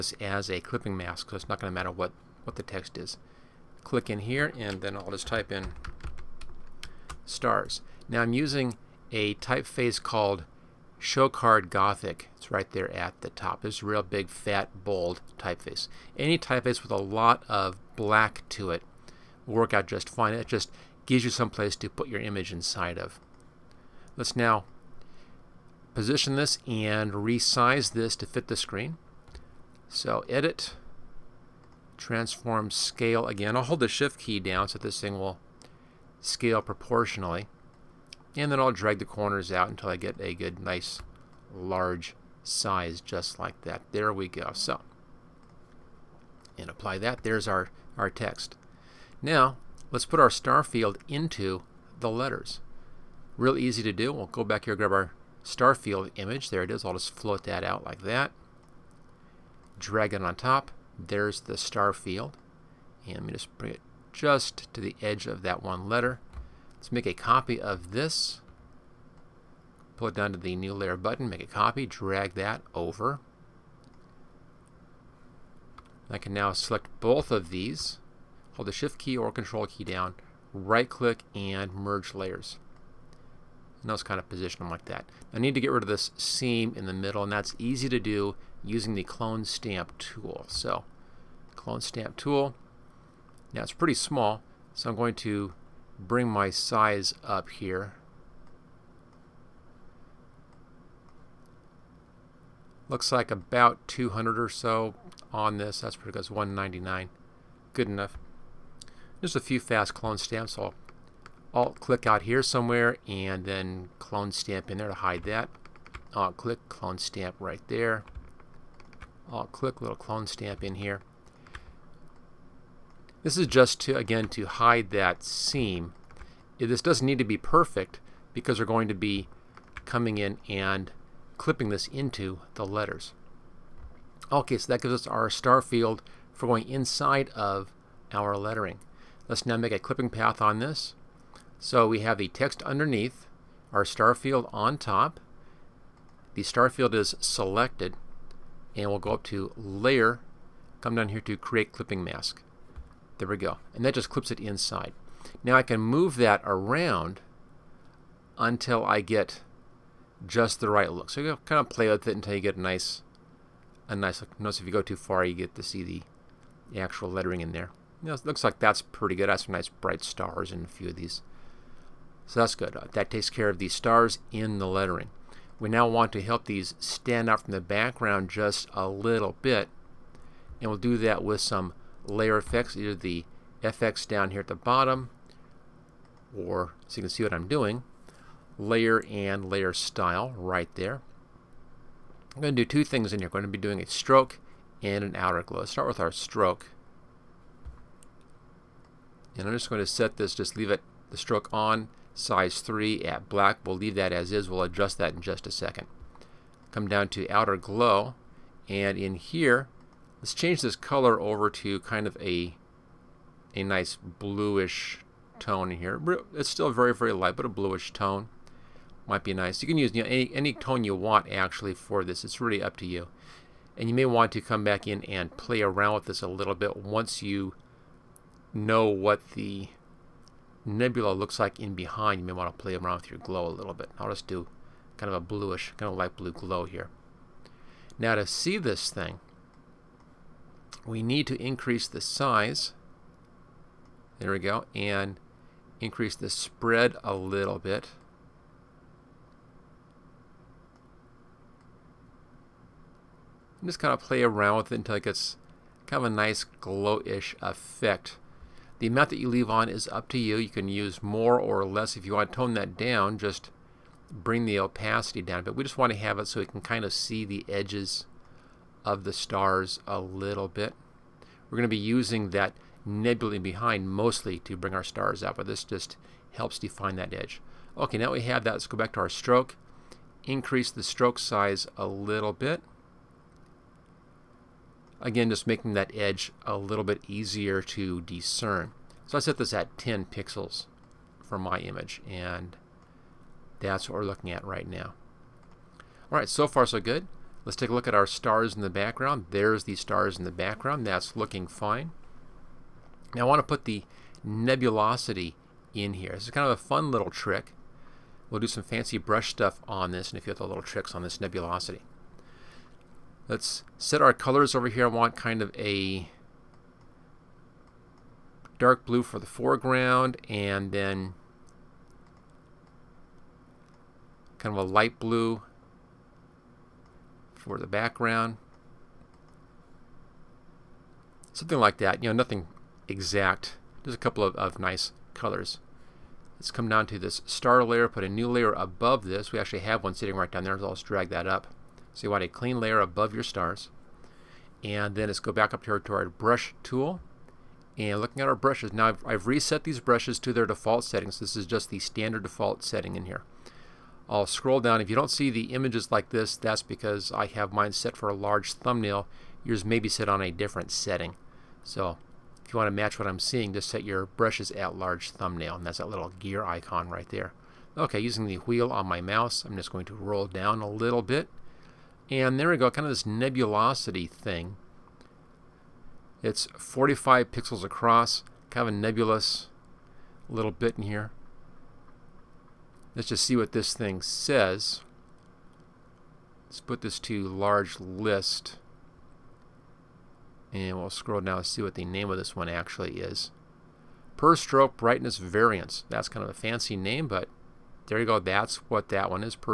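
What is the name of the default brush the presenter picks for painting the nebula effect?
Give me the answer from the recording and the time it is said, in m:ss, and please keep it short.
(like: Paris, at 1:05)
Per stroke brightness variance, at 6:34.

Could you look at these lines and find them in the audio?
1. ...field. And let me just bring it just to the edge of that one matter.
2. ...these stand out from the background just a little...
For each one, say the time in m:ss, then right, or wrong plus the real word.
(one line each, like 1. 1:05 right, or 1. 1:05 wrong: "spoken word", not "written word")
1. 1:01 wrong: "letter", not "matter"
2. 2:56 right.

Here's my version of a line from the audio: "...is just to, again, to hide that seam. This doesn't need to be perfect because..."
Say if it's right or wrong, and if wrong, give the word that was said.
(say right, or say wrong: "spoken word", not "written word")
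right.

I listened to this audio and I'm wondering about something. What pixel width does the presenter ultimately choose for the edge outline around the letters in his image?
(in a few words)
10 pixels.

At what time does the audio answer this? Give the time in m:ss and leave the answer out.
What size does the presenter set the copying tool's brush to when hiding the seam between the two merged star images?
1:46.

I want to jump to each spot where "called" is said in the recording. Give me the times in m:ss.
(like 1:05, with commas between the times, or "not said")
0:10.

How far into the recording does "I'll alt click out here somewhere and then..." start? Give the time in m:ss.
1:50.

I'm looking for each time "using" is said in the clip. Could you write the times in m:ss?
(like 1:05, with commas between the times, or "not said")
0:08, 1:28, 4:31, 6:07.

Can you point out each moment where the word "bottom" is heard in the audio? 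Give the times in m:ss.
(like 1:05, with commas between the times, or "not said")
3:04.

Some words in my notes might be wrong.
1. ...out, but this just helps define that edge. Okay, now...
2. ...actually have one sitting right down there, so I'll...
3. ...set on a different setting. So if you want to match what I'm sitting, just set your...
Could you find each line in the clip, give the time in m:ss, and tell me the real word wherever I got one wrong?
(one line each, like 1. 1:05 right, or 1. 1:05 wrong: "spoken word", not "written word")
1. 4:35 right
2. 5:39 right
3. 5:59 wrong: "seeing", not "sitting".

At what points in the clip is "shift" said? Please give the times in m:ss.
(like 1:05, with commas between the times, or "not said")
0:33, 1:18.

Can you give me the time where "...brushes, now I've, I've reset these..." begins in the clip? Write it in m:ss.
5:48.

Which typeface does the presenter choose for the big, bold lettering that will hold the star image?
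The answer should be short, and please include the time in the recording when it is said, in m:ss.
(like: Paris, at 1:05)
Showcard Gothic, at 0:10.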